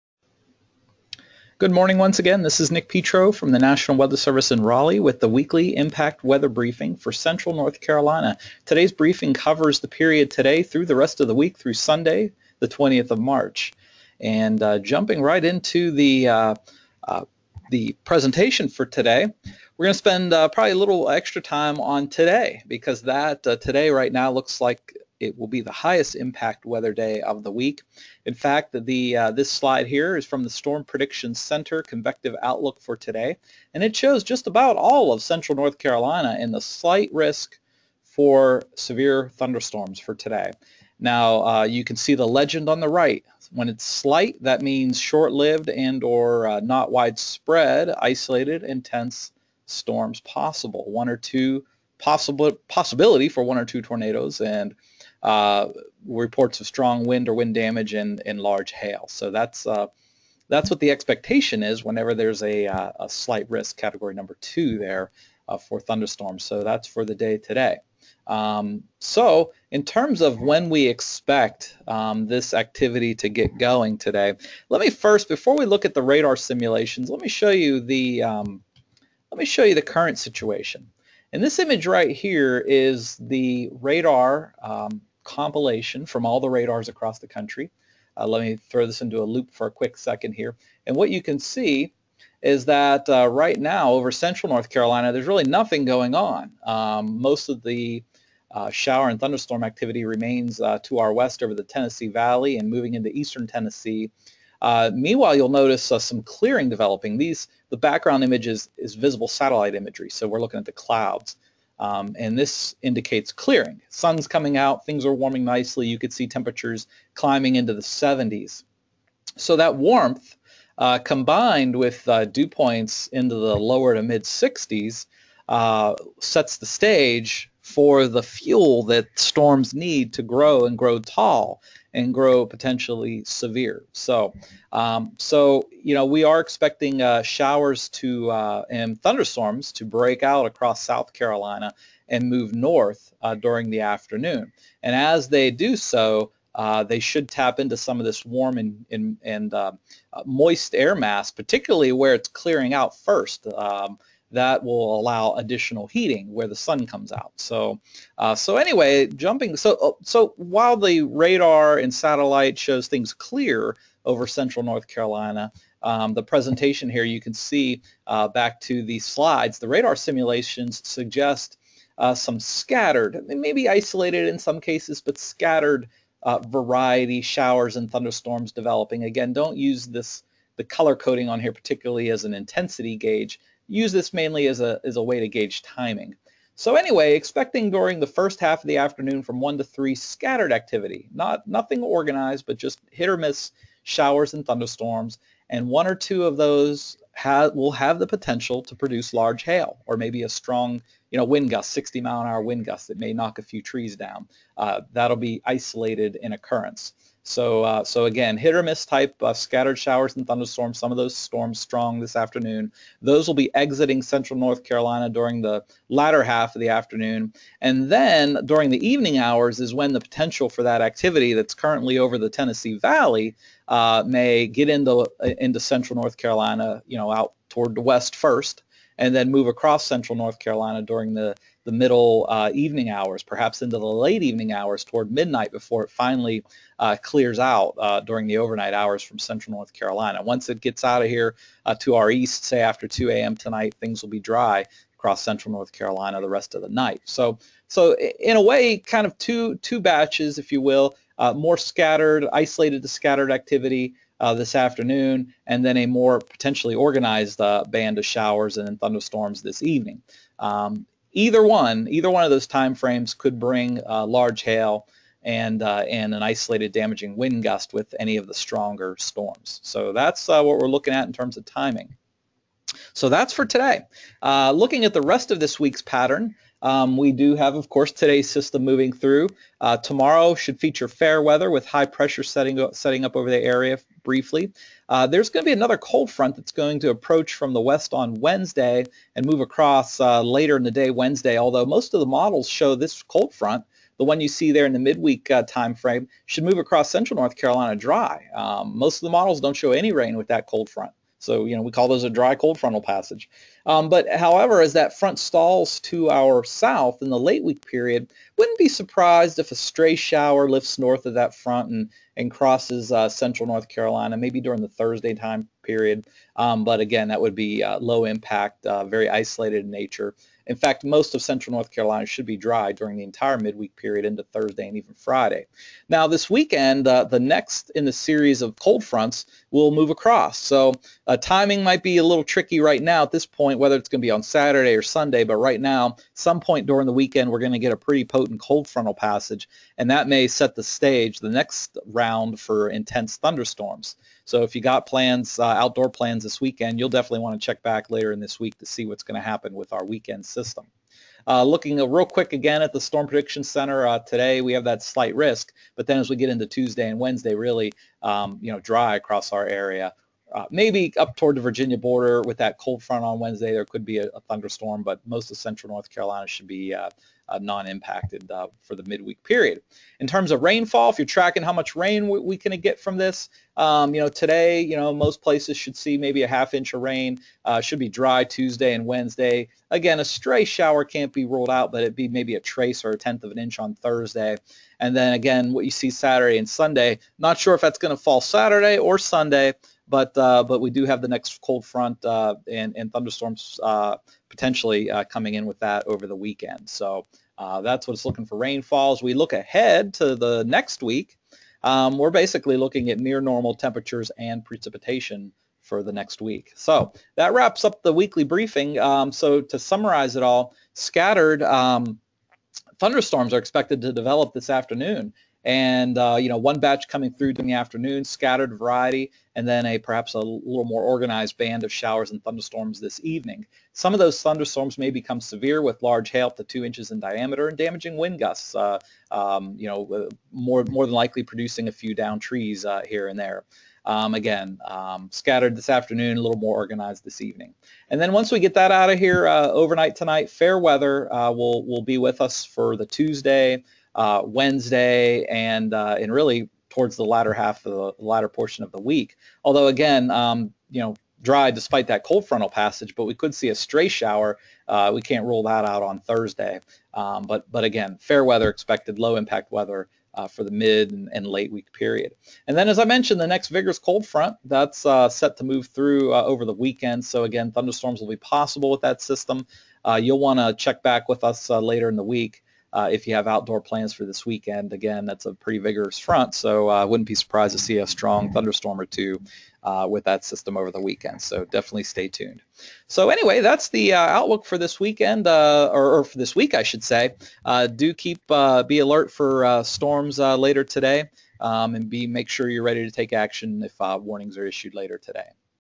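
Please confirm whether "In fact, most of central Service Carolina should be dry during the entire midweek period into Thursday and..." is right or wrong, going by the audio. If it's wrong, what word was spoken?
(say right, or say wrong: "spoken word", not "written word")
wrong: "North", not "Service".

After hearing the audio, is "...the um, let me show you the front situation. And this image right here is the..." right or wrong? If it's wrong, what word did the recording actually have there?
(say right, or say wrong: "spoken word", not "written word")
wrong: "current", not "front".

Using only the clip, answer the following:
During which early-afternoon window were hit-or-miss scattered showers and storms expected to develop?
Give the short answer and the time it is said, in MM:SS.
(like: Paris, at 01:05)
1 to 3, at 03:09.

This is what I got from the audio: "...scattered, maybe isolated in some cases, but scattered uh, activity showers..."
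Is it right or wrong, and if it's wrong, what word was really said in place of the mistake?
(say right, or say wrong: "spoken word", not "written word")
wrong: "variety", not "activity".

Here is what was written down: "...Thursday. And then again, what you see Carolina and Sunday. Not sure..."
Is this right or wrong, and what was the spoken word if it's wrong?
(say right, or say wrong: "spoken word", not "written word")
wrong: "Saturday", not "Carolina".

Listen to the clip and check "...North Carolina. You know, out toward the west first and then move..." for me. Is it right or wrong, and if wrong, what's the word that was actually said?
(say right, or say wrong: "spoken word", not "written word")
right.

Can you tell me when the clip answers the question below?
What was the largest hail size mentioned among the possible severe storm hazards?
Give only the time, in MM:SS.
07:06.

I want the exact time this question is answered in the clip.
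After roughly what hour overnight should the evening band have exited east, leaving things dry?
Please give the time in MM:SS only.
04:02.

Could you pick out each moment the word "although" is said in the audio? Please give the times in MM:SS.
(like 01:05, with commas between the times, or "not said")
04:51, 07:29.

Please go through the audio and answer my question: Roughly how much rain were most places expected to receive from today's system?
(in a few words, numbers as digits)
half inch.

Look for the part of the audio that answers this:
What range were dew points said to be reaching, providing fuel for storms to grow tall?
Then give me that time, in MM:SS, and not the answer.
02:03.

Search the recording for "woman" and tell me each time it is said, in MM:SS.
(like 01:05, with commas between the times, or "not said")
not said.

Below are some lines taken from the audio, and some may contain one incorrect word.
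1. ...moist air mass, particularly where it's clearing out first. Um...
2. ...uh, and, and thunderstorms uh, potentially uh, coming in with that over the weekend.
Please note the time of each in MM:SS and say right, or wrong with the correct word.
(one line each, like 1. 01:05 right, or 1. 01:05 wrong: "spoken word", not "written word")
1. 02:30 right
2. 06:32 right.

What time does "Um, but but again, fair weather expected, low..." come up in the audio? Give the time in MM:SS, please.
07:36.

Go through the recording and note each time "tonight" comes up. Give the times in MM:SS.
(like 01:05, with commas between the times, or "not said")
04:03, 07:19.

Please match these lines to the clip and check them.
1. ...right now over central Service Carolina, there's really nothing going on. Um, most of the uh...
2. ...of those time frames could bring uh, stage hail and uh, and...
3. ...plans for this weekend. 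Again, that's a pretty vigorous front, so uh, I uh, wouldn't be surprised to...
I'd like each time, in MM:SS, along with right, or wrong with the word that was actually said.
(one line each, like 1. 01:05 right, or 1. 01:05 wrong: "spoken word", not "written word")
1. 01:33 wrong: "North", not "Service"
2. 04:22 wrong: "large", not "stage"
3. 07:53 right.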